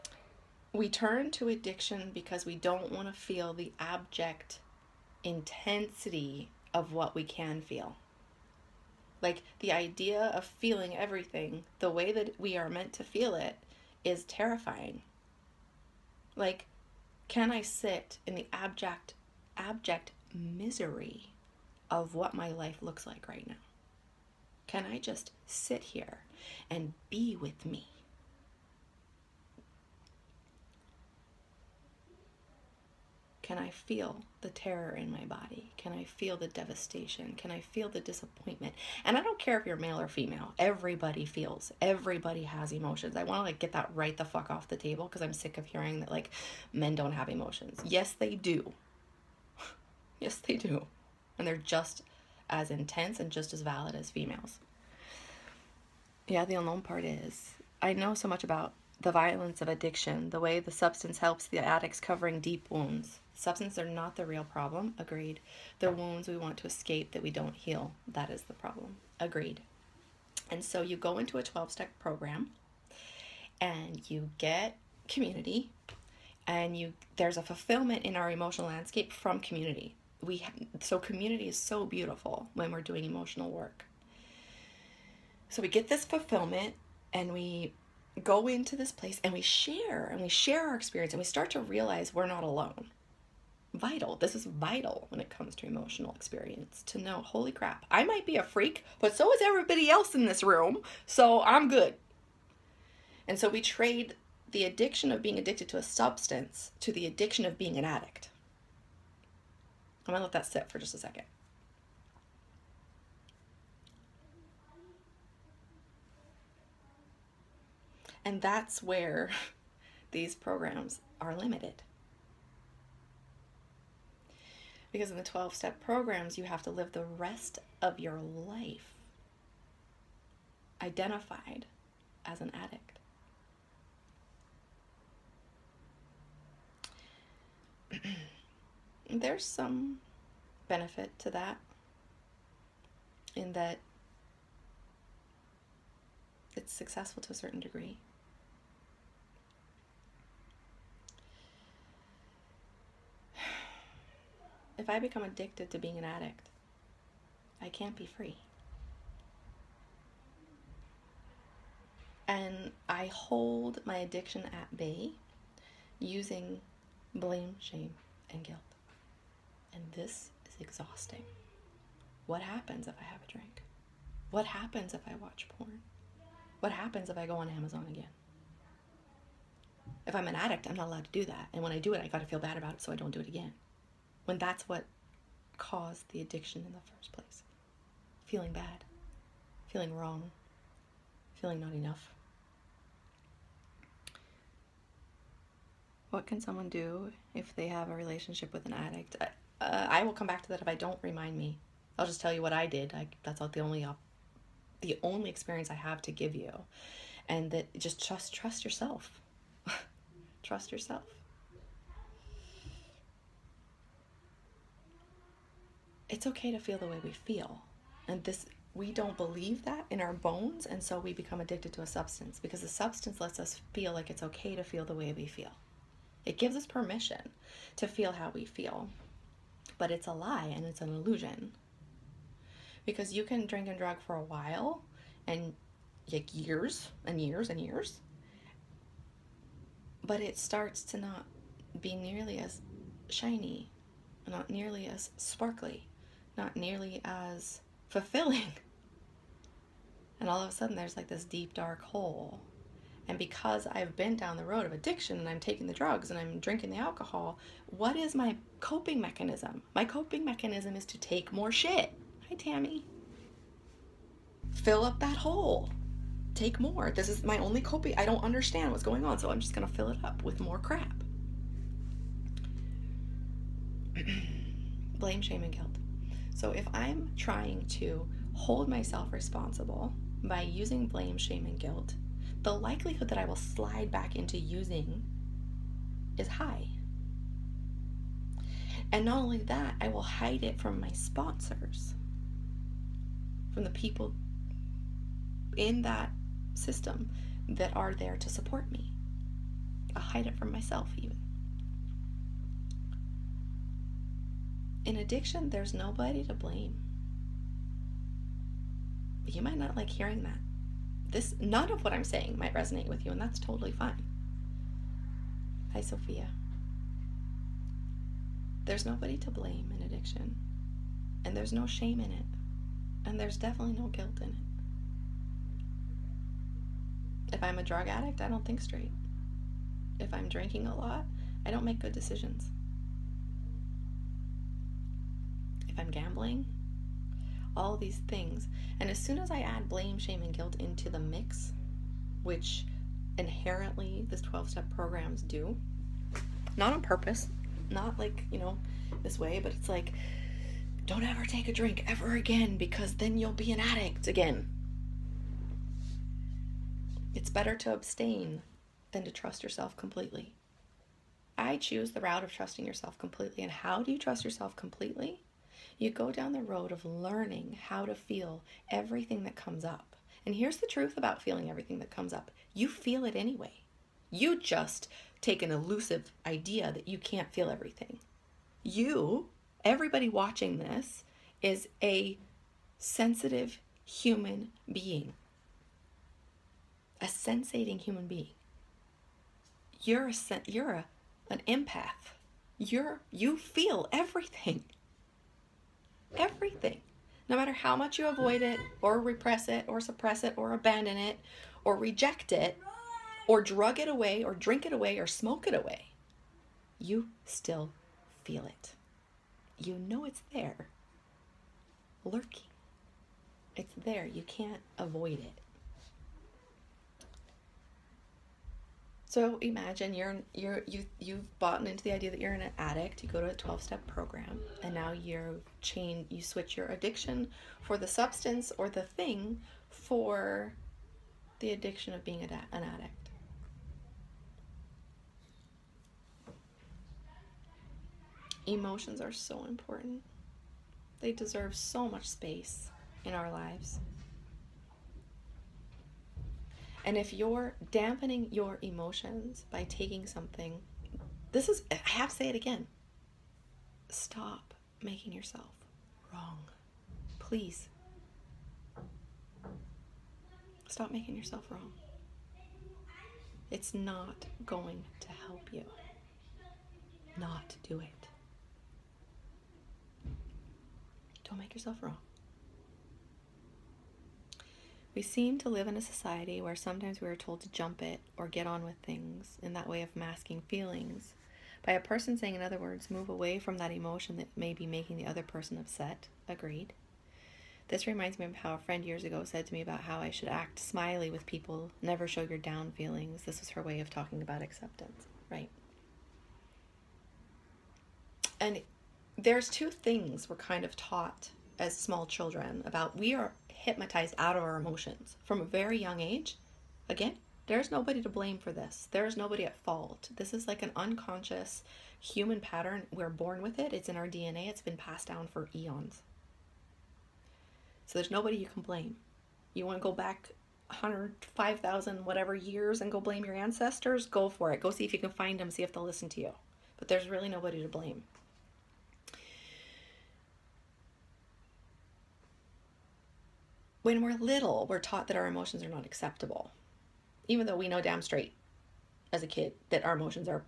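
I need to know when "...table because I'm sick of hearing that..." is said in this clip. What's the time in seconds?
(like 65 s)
44 s.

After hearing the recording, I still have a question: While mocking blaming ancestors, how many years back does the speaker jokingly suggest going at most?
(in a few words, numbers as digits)
5,000.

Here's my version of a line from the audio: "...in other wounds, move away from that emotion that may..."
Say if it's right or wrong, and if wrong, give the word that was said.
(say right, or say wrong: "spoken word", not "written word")
wrong: "words", not "wounds".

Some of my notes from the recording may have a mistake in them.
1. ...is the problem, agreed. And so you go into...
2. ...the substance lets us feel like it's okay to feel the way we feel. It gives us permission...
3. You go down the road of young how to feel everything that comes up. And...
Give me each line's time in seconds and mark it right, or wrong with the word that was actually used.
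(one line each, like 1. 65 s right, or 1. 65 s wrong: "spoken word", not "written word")
1. 68 s right
2. 222 s right
3. 365 s wrong: "learning", not "young".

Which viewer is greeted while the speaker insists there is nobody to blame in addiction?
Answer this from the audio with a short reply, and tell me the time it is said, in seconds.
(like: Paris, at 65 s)
Sophia, at 315 s.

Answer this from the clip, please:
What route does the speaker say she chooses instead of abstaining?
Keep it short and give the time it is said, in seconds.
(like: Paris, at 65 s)
trusting yourself completely, at 362 s.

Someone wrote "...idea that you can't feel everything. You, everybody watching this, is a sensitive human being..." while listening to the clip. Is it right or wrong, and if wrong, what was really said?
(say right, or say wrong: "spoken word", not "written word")
right.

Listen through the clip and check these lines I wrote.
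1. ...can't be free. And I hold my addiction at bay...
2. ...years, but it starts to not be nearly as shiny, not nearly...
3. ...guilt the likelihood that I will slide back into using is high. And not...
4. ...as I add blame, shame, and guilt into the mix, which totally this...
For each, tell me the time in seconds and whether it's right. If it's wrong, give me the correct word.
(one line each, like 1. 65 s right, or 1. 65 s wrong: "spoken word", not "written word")
1. 157 s right
2. 237 s right
3. 281 s right
4. 339 s wrong: "inherently", not "totally".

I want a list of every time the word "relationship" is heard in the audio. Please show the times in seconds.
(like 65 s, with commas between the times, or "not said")
197 s.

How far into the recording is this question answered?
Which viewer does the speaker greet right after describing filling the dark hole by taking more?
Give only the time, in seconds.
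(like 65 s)
262 s.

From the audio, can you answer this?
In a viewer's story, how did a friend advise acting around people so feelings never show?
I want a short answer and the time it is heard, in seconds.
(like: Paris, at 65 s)
smiley, at 490 s.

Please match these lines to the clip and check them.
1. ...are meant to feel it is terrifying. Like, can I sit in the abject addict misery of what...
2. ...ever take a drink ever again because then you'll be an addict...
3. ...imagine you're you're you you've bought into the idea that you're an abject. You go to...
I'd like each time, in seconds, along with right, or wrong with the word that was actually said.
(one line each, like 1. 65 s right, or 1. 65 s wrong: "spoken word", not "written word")
1. 12 s wrong: "abject", not "addict"
2. 351 s right
3. 419 s wrong: "addict", not "abject".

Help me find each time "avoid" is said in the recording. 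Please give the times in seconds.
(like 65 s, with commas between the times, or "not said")
398 s, 414 s.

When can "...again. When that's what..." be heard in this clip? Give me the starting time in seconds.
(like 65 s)
183 s.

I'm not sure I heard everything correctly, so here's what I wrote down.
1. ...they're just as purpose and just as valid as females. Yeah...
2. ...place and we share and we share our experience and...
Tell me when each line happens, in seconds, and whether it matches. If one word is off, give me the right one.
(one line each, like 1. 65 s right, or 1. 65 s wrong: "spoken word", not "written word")
1. 51 s wrong: "intense", not "purpose"
2. 88 s right.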